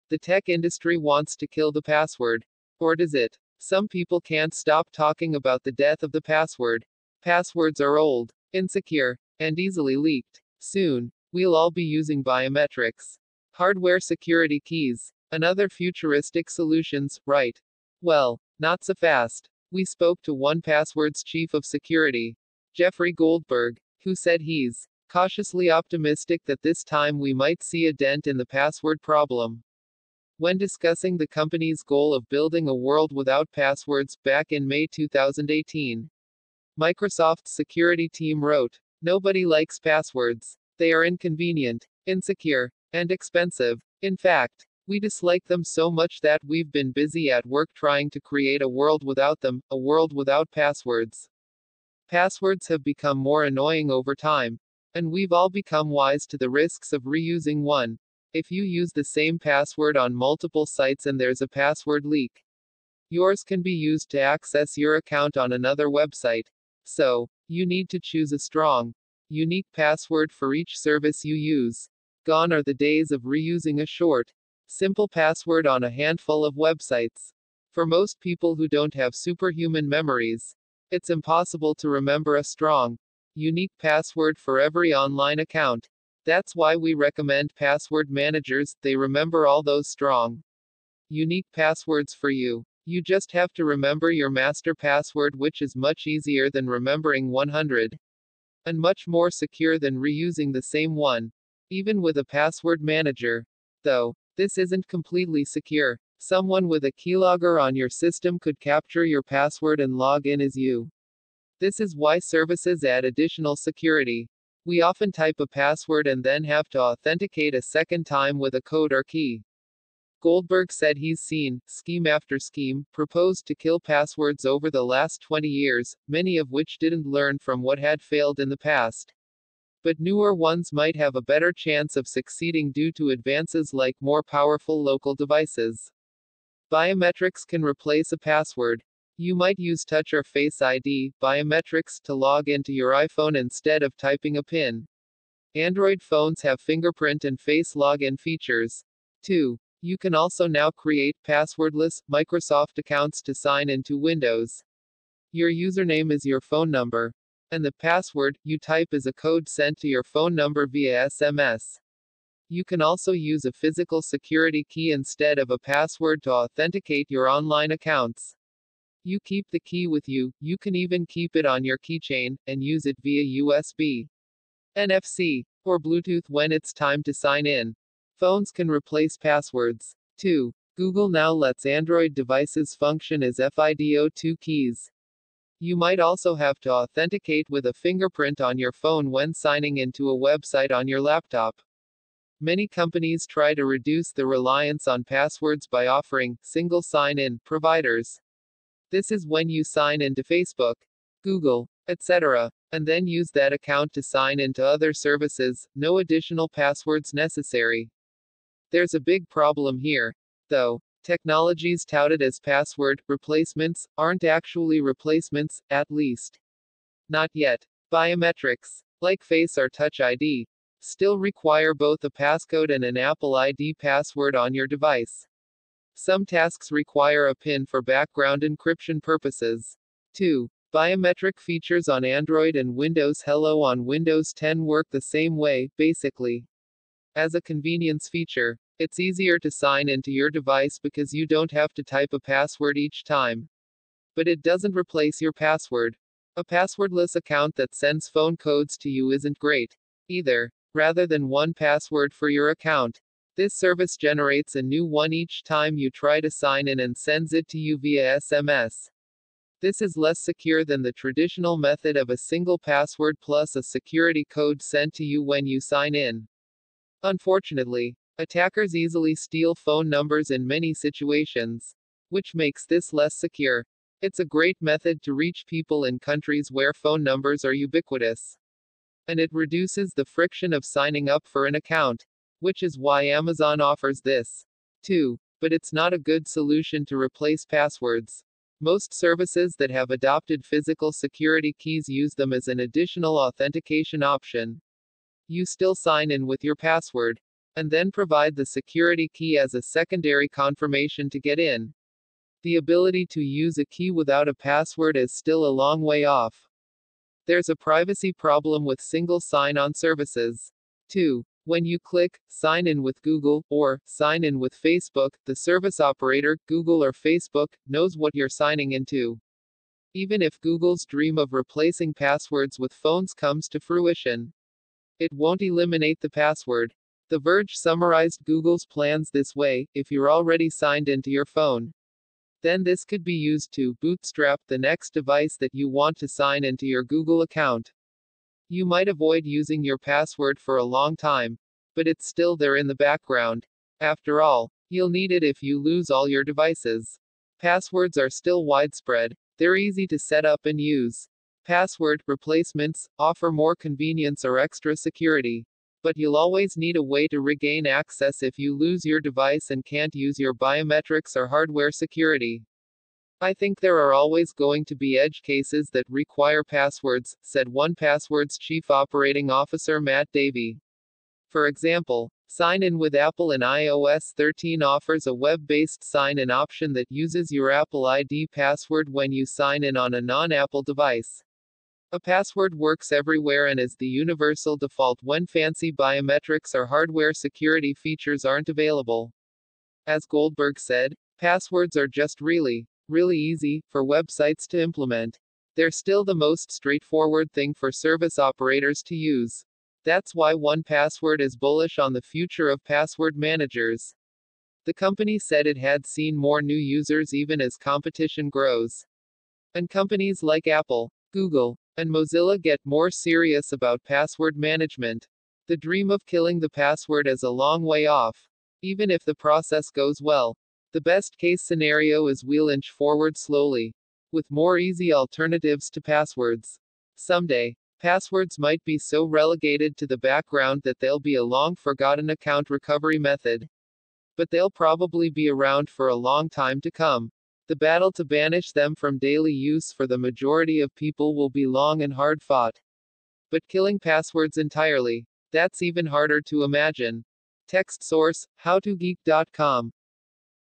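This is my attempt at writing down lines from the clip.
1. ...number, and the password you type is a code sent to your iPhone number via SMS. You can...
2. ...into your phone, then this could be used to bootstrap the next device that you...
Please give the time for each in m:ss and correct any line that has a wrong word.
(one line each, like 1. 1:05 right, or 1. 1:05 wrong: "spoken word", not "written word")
1. 2:36 wrong: "phone", not "iPhone"
2. 5:30 right.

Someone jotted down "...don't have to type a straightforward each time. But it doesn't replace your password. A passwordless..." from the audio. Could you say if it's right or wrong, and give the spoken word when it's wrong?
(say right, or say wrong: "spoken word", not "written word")
wrong: "password", not "straightforward".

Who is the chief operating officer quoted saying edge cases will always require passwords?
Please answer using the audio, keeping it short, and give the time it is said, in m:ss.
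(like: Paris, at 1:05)
Matt Davey, at 6:09.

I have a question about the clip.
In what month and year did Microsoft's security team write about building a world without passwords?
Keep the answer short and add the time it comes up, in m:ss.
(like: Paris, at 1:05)
May 2018, at 0:34.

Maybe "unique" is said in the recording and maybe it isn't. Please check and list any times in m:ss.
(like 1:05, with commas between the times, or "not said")
1:09, 1:23, 1:31.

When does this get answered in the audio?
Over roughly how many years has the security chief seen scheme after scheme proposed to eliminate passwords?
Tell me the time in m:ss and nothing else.
2:05.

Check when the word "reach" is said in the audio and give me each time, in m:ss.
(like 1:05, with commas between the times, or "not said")
4:35.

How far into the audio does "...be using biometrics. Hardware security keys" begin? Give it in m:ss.
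0:11.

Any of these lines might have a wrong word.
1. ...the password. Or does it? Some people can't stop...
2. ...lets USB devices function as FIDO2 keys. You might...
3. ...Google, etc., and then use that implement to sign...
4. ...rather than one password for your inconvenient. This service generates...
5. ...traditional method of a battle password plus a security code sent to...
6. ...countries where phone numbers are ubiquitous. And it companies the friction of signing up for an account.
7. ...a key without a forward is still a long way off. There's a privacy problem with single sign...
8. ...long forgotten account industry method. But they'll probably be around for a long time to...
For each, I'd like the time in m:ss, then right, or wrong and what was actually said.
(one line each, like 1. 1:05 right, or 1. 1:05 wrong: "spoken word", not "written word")
1. 0:01 right
2. 3:01 wrong: "Android", not "USB"
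3. 3:21 wrong: "account", not "implement"
4. 4:10 wrong: "account", not "inconvenient"
5. 4:20 wrong: "single", not "battle"
6. 4:35 wrong: "reduces", not "companies"
7. 5:03 wrong: "password", not "forward"
8. 7:11 wrong: "recovery", not "industry".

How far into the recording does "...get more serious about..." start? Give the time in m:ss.
6:52.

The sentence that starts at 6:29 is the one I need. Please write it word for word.
As Goldberg said, passwords are just really really easy for websites to implement.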